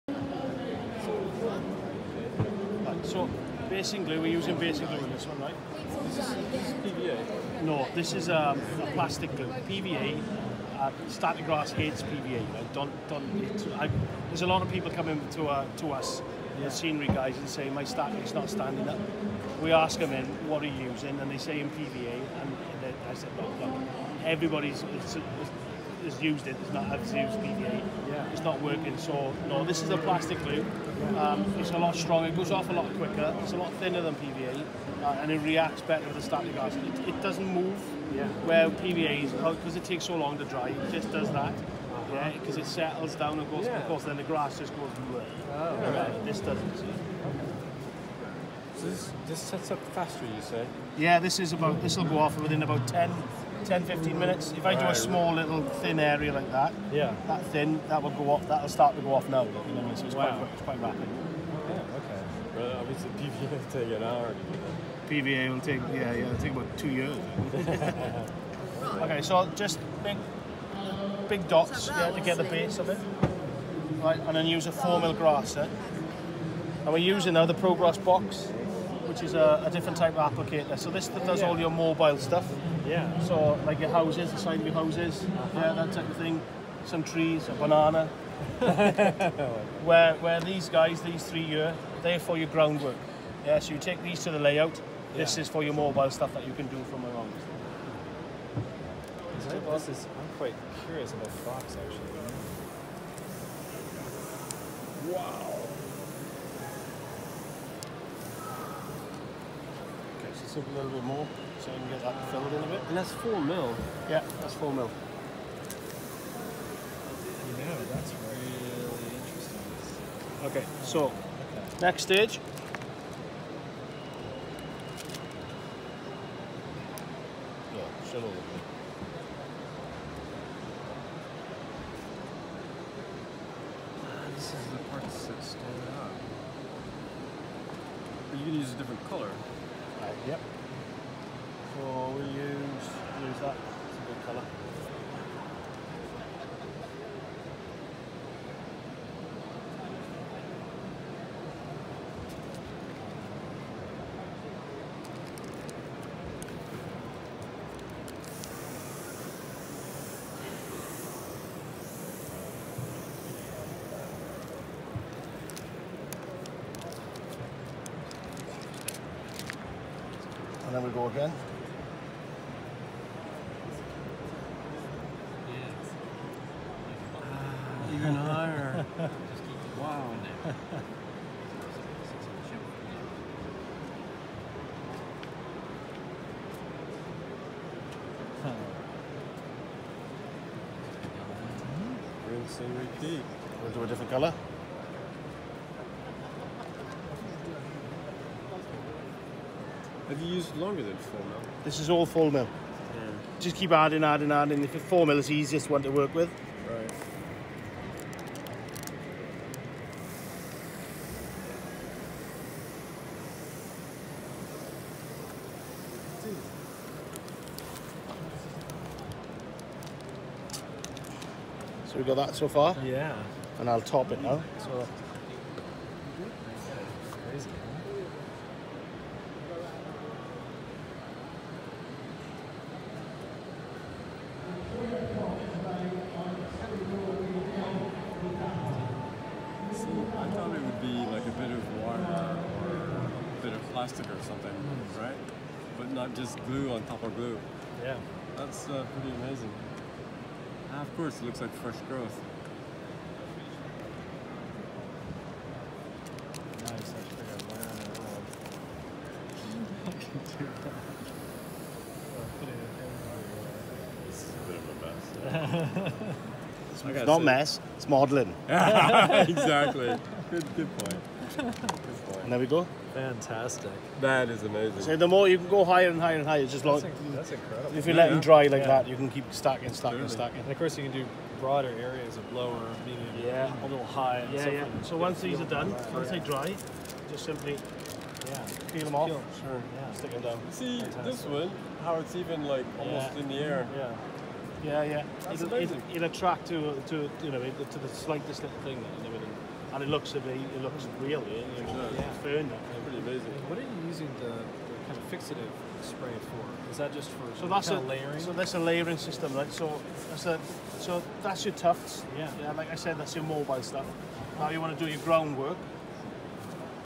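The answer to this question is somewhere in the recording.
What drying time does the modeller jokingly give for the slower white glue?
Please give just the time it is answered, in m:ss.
1:06.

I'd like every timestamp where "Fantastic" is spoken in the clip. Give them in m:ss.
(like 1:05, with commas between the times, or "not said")
4:32, 4:50.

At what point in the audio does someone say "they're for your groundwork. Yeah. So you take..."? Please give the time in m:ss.
1:32.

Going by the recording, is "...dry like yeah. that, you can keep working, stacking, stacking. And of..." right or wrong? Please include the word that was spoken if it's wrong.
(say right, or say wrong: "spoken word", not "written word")
wrong: "stacking", not "working".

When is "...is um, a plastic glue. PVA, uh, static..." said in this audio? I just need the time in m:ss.
0:08.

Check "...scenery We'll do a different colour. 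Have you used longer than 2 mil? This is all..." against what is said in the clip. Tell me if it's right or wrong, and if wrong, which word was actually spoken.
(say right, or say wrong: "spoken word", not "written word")
wrong: "4", not "2".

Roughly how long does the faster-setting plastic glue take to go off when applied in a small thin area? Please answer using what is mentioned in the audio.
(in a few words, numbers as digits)
10-15 minutes.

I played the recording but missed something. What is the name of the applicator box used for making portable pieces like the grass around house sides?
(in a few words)
Prograss box.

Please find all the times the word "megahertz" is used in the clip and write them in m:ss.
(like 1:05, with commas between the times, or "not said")
not said.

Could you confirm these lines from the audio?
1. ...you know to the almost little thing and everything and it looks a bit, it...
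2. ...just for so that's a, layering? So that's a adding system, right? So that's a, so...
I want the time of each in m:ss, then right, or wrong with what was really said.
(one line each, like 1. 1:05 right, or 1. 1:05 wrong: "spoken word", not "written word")
1. 4:57 wrong: "slightest", not "almost"
2. 5:06 wrong: "layering", not "adding".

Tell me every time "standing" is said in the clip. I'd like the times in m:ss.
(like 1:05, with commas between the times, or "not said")
0:18, 2:15.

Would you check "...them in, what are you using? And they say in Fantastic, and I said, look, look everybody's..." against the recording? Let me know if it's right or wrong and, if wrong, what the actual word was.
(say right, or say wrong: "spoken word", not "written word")
wrong: "PVA", not "Fantastic".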